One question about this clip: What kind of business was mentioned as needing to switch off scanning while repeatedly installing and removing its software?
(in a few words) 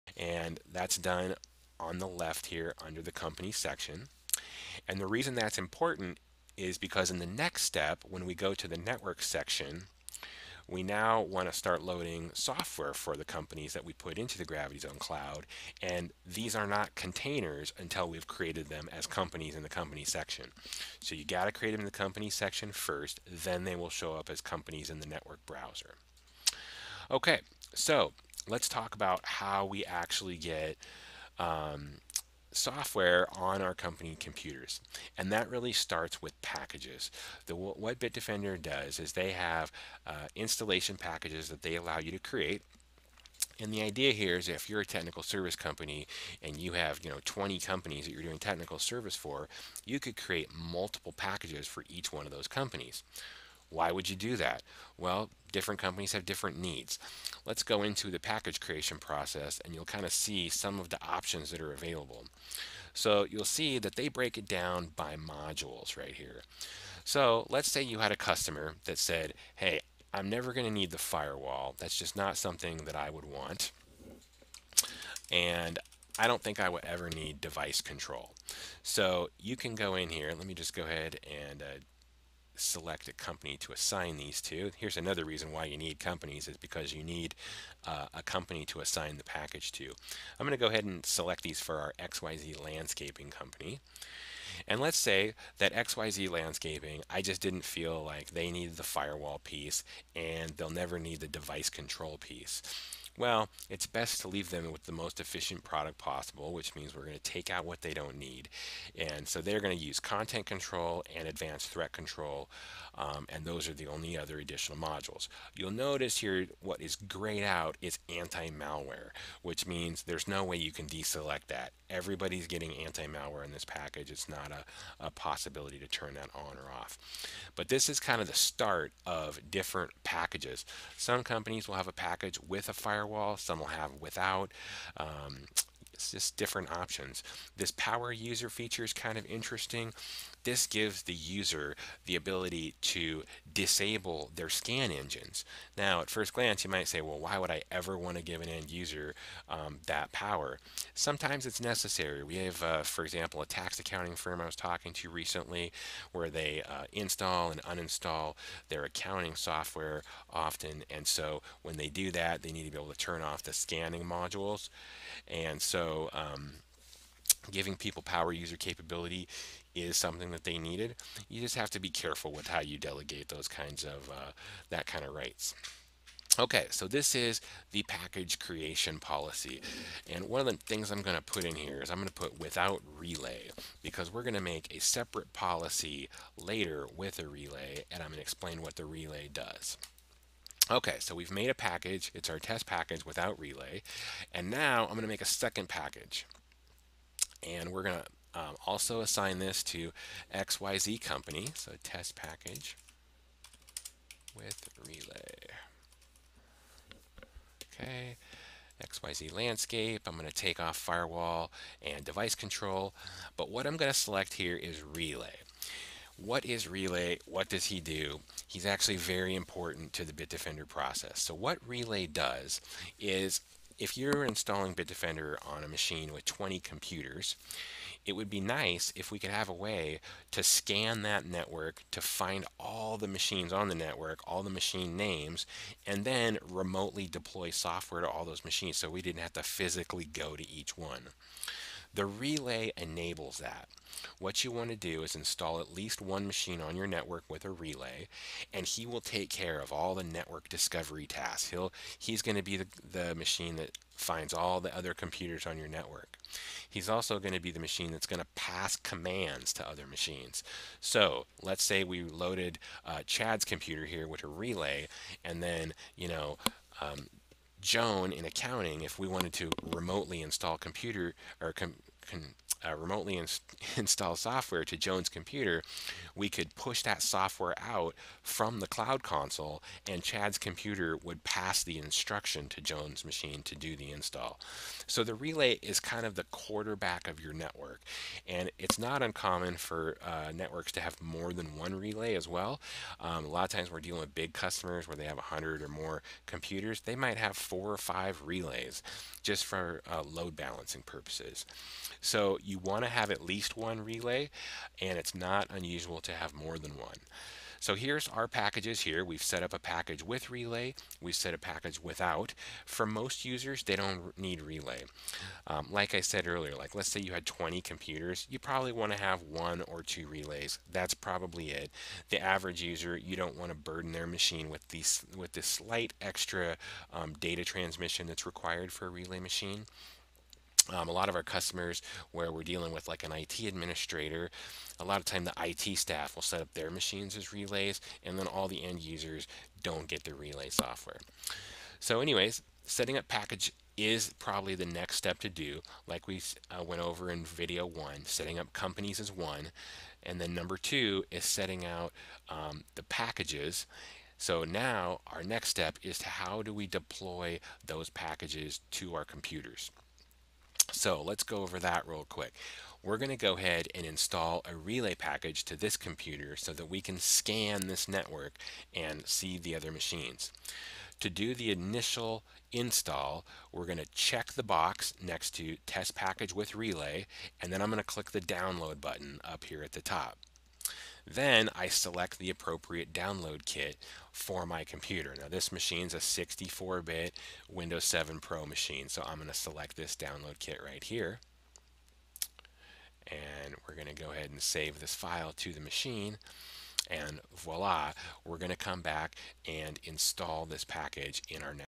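tax accounting firm.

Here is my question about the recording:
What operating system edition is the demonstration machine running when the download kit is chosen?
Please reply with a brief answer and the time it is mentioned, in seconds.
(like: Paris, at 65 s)
Windows 7 Pro, at 387 s.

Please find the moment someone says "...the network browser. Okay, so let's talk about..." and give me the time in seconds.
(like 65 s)
24 s.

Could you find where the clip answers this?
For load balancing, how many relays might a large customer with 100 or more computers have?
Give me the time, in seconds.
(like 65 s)
297 s.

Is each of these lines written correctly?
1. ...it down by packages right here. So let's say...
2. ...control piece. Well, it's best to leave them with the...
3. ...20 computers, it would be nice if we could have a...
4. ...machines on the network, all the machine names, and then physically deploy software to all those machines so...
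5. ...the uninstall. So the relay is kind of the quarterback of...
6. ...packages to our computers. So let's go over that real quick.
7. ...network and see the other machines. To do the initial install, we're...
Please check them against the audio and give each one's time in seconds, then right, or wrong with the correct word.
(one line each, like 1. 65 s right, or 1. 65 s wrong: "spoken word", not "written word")
1. 64 s wrong: "modules", not "packages"
2. 101 s right
3. 226 s right
4. 233 s wrong: "remotely", not "physically"
5. 283 s wrong: "install", not "uninstall"
6. 357 s right
7. 367 s right.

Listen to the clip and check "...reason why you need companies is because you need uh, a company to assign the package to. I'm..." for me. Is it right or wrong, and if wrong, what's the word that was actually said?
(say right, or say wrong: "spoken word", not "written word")
right.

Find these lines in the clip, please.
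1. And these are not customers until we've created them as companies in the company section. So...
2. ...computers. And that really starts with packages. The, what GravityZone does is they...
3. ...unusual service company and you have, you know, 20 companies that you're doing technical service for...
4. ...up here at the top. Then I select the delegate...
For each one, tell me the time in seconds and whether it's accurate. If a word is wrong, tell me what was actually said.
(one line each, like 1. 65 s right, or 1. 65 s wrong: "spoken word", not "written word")
1. 15 s wrong: "containers", not "customers"
2. 34 s wrong: "Bitdefender", not "GravityZone"
3. 44 s wrong: "technical", not "unusual"
4. 379 s wrong: "appropriate", not "delegate".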